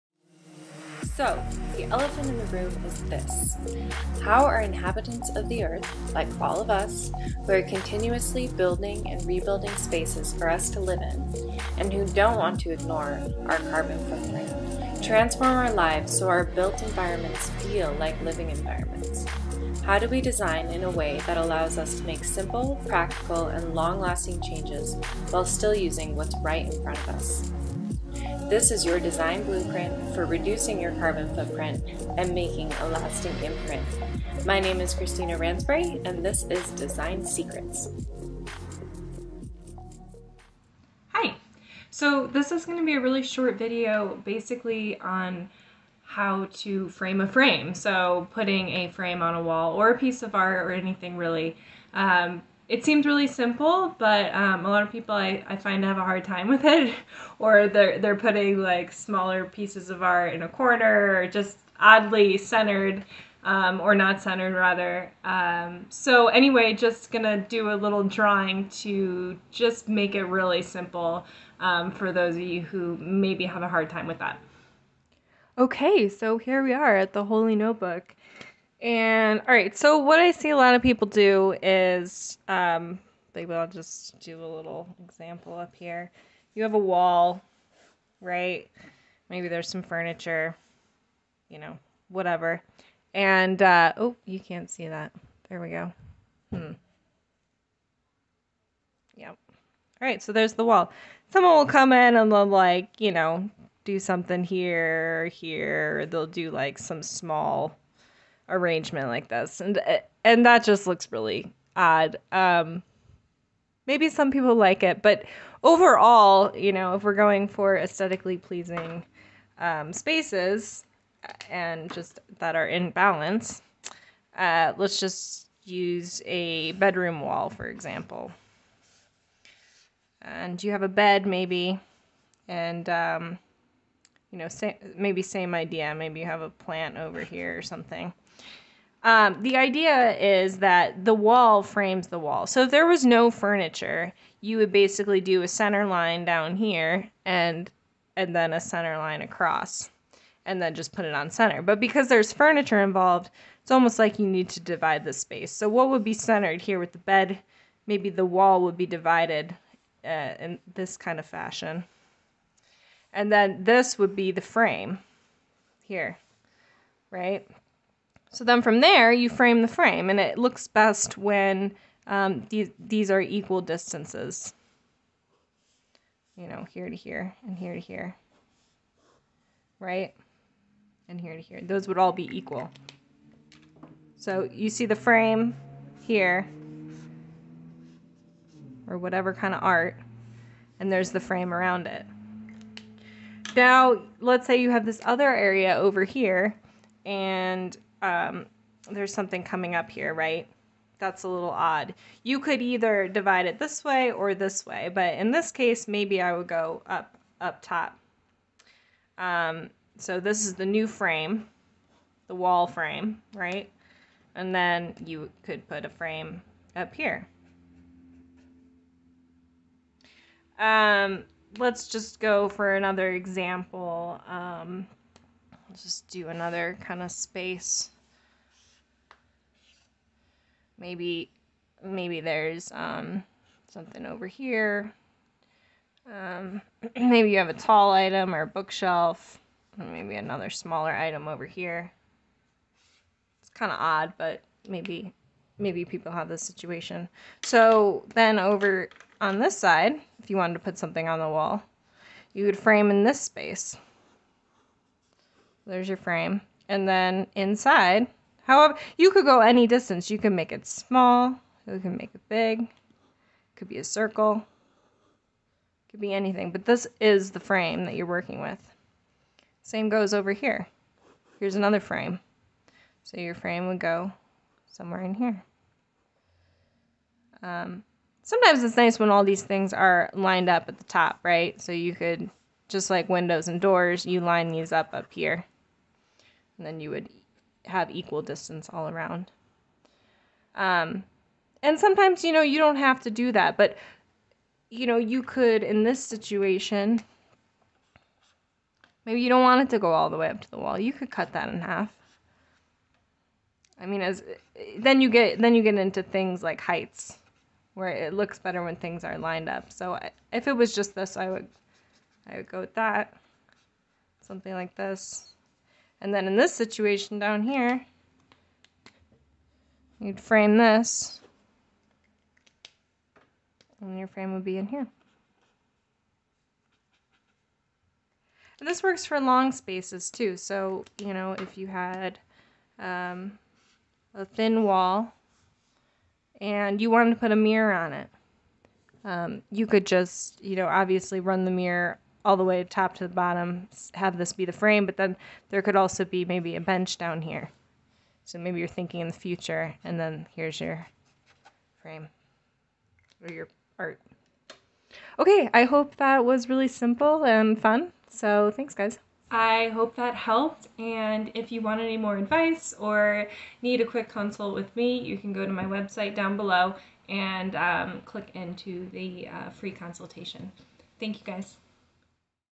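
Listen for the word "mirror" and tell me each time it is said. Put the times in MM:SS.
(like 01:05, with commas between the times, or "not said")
05:37, 05:41.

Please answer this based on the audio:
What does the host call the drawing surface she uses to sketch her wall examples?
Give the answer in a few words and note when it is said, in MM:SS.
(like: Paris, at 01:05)
the Holy Notebook, at 01:17.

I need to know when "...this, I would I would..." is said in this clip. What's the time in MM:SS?
05:10.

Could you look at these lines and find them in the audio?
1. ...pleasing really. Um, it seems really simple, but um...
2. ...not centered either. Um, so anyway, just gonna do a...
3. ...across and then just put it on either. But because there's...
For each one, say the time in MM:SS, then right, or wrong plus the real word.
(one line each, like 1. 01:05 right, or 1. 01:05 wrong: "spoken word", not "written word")
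1. 00:50 wrong: "anything", not "pleasing"
2. 01:03 wrong: "rather", not "either"
3. 02:29 wrong: "center", not "either".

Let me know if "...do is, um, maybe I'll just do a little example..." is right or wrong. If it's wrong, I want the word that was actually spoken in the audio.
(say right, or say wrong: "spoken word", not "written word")
right.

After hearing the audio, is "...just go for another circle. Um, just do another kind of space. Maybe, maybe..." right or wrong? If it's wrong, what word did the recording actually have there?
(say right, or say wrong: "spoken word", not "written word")
wrong: "example", not "circle".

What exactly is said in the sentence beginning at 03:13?
Now, let's say you have this other area over here, and um, there's something coming up here, right?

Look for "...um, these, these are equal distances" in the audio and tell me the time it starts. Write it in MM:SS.
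02:52.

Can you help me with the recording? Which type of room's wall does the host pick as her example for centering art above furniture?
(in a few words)
a bedroom.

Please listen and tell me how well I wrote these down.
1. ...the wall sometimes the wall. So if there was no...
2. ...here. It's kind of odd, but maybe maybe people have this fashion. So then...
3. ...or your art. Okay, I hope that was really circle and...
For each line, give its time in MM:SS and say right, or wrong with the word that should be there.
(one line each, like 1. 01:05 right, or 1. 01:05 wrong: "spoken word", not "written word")
1. 02:21 wrong: "frames", not "sometimes"
2. 04:01 wrong: "situation", not "fashion"
3. 05:53 wrong: "simple", not "circle".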